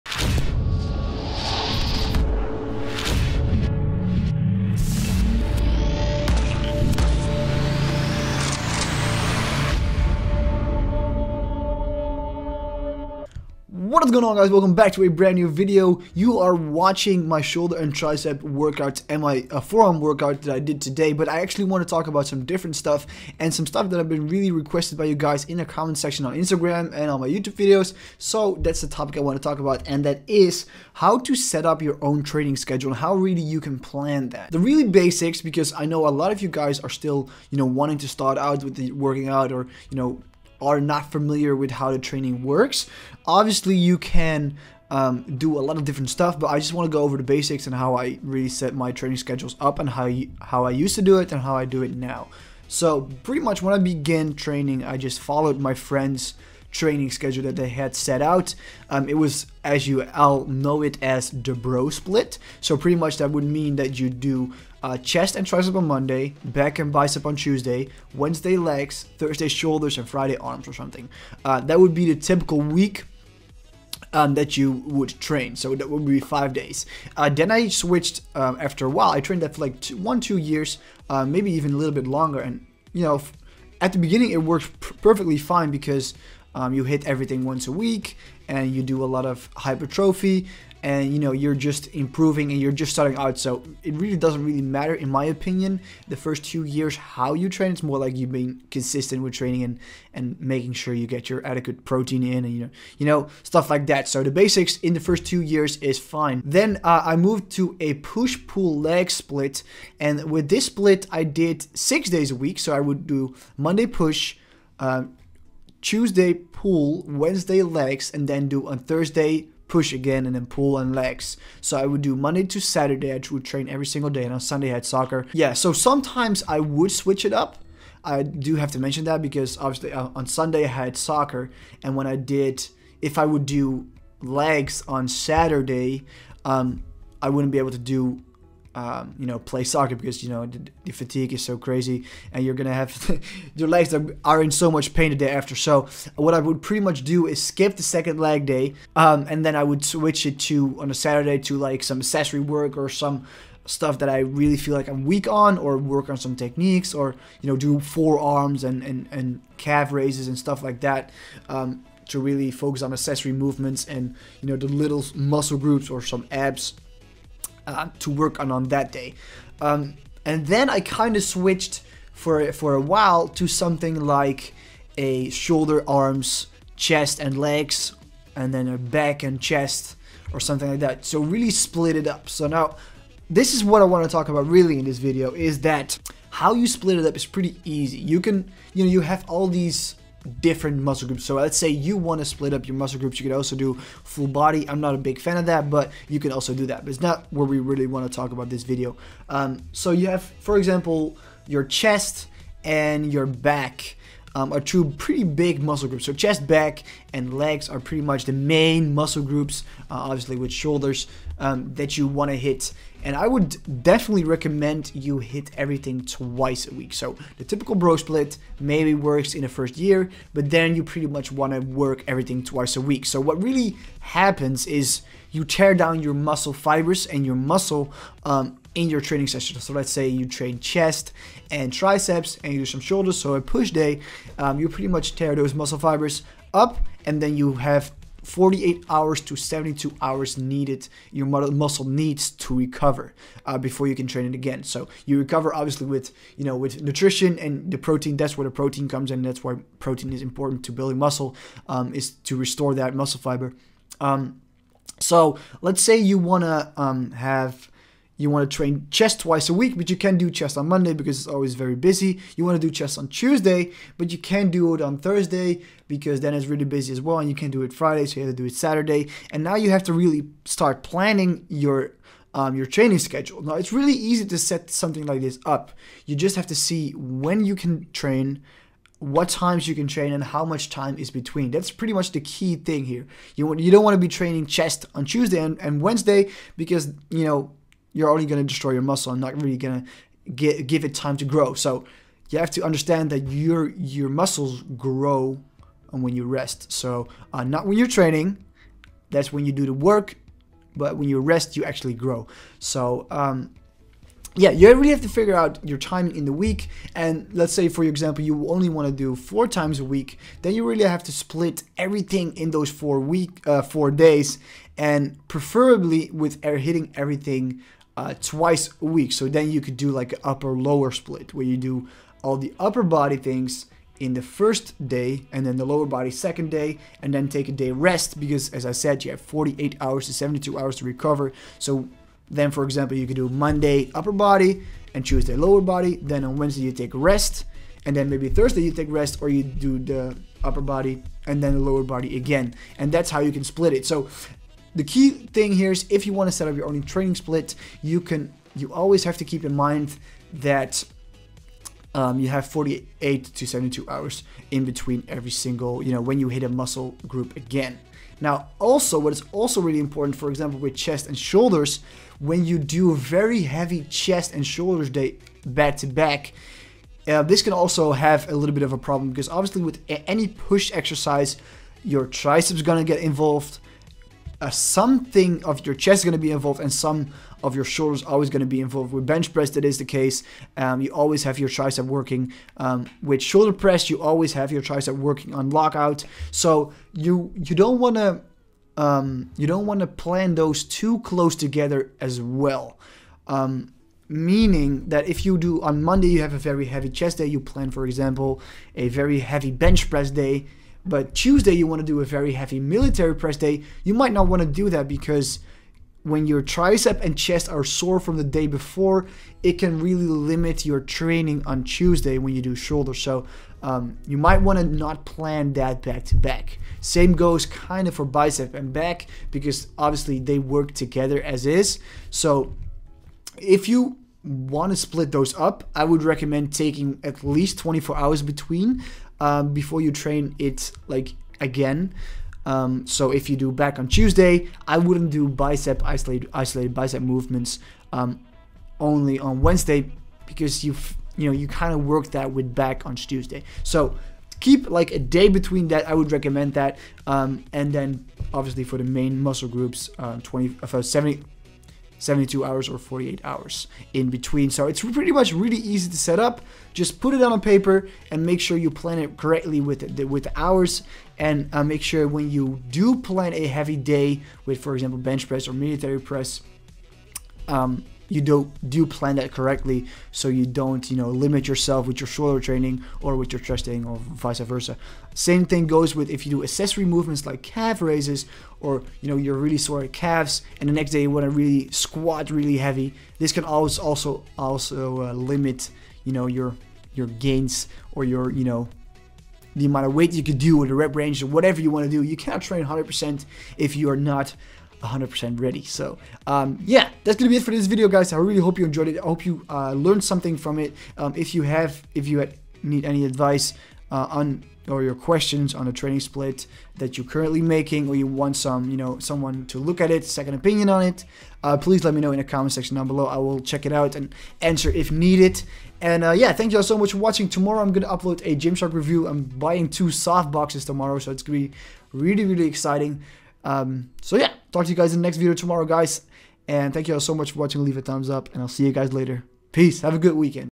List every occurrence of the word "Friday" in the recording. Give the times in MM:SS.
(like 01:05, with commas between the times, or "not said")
01:10, 04:27.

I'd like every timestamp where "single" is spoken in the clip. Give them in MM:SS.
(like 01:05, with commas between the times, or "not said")
02:03, 05:55.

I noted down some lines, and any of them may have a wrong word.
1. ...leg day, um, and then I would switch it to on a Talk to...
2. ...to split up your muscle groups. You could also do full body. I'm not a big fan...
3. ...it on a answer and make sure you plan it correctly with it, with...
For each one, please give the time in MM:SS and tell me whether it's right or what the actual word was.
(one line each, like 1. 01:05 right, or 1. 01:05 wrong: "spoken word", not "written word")
1. 02:28 wrong: "Saturday", not "Talk"
2. 03:12 right
3. 07:37 wrong: "paper", not "answer".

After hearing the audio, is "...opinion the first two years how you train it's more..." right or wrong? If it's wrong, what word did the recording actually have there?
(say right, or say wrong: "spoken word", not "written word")
right.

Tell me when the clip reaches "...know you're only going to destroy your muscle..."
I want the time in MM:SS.
04:47.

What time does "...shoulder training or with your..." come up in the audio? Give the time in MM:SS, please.
07:52.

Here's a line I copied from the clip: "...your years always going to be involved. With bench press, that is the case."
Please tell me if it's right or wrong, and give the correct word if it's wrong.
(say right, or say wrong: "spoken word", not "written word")
wrong: "shoulders", not "years".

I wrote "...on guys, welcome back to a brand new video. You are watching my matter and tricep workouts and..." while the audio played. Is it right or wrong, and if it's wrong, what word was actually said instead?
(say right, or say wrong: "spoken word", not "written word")
wrong: "shoulder", not "matter".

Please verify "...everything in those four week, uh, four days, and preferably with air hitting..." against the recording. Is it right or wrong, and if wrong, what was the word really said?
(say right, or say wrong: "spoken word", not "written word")
right.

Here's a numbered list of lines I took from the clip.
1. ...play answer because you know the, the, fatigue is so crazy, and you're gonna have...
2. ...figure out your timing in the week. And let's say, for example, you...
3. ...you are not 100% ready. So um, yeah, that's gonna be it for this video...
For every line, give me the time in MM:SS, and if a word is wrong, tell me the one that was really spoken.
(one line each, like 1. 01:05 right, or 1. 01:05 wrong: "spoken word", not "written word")
1. 02:19 wrong: "soccer", not "answer"
2. 05:05 right
3. 08:13 right.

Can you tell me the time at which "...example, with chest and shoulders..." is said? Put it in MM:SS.
06:00.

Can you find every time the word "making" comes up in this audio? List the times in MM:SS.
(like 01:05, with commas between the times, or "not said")
01:40, 08:27.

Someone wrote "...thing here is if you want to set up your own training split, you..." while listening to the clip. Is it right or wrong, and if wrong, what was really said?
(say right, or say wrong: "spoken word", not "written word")
right.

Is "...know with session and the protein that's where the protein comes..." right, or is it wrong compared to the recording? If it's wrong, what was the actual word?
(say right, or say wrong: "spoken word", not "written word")
wrong: "nutrition", not "session".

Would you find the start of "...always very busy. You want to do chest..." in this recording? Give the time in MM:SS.
04:21.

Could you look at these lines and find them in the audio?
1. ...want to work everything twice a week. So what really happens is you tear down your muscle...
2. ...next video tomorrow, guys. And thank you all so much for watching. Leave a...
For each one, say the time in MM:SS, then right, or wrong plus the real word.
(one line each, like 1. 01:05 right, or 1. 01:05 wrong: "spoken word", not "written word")
1. 03:41 right
2. 08:45 right.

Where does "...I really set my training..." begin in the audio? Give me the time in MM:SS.
00:47.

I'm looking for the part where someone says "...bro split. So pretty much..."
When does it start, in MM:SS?
01:01.